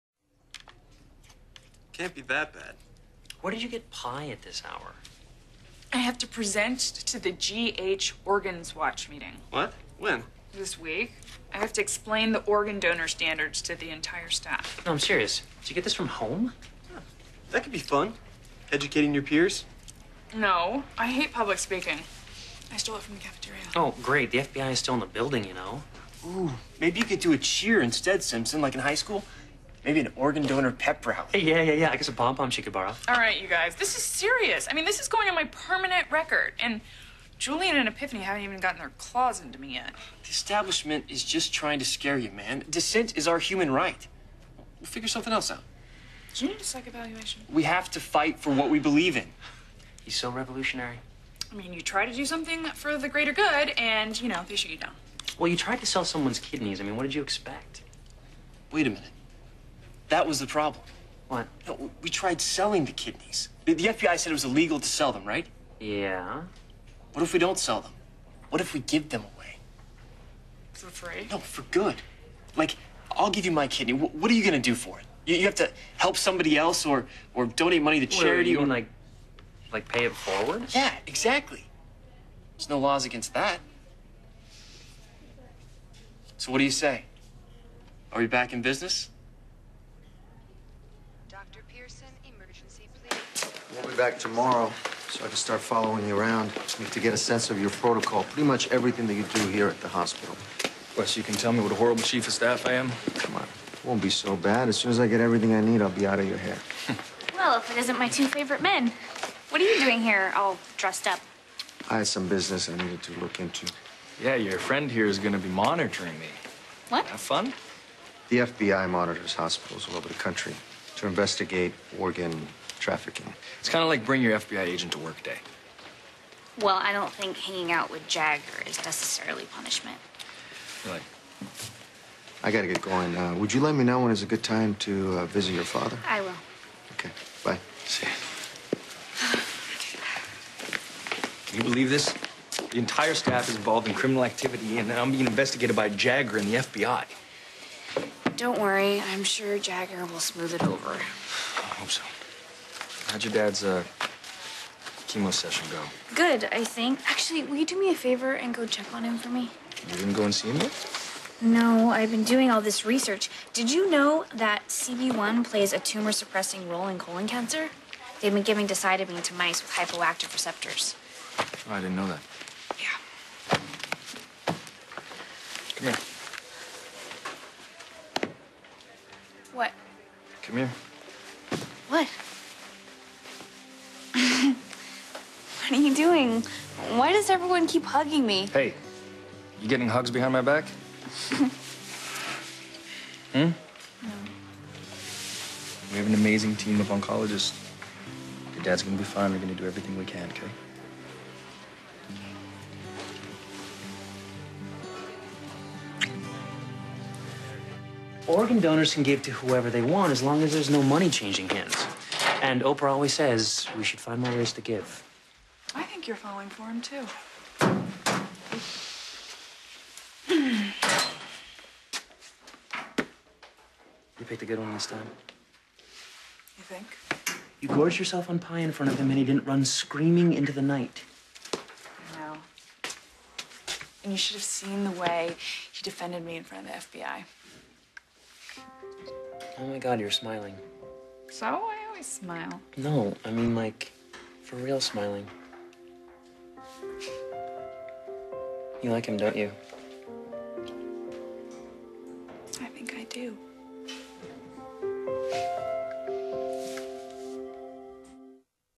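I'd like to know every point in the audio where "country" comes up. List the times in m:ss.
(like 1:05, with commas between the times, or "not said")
2:00.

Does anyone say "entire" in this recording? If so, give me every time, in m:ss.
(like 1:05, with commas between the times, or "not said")
0:13, 2:22.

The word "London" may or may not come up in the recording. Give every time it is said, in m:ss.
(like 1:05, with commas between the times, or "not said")
not said.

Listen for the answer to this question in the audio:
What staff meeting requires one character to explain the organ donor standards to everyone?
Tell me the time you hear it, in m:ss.
0:07.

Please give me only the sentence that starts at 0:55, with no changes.
Well, you tried to sell someone's kidneys.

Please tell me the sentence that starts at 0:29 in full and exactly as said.
Maybe an organ donor pep rally.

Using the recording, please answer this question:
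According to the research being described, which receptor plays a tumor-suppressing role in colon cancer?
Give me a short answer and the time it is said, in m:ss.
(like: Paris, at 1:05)
CB1, at 2:44.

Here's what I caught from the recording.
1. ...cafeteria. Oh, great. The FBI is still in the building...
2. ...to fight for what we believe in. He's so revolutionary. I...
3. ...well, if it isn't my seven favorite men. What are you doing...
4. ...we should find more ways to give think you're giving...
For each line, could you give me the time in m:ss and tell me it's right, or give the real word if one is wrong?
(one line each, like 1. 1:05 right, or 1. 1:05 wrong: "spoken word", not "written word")
1. 0:23 right
2. 0:47 right
3. 1:47 wrong: "two", not "seven"
4. 3:33 wrong: "falling", not "giving".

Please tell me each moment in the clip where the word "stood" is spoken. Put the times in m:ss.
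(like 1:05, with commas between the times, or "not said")
not said.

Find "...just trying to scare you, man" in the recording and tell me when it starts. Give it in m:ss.
0:41.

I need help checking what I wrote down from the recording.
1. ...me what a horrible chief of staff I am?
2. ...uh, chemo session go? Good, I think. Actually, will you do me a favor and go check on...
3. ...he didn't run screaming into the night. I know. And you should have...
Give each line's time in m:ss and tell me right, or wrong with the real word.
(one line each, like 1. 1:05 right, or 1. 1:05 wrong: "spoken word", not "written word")
1. 1:41 right
2. 2:33 right
3. 3:49 right.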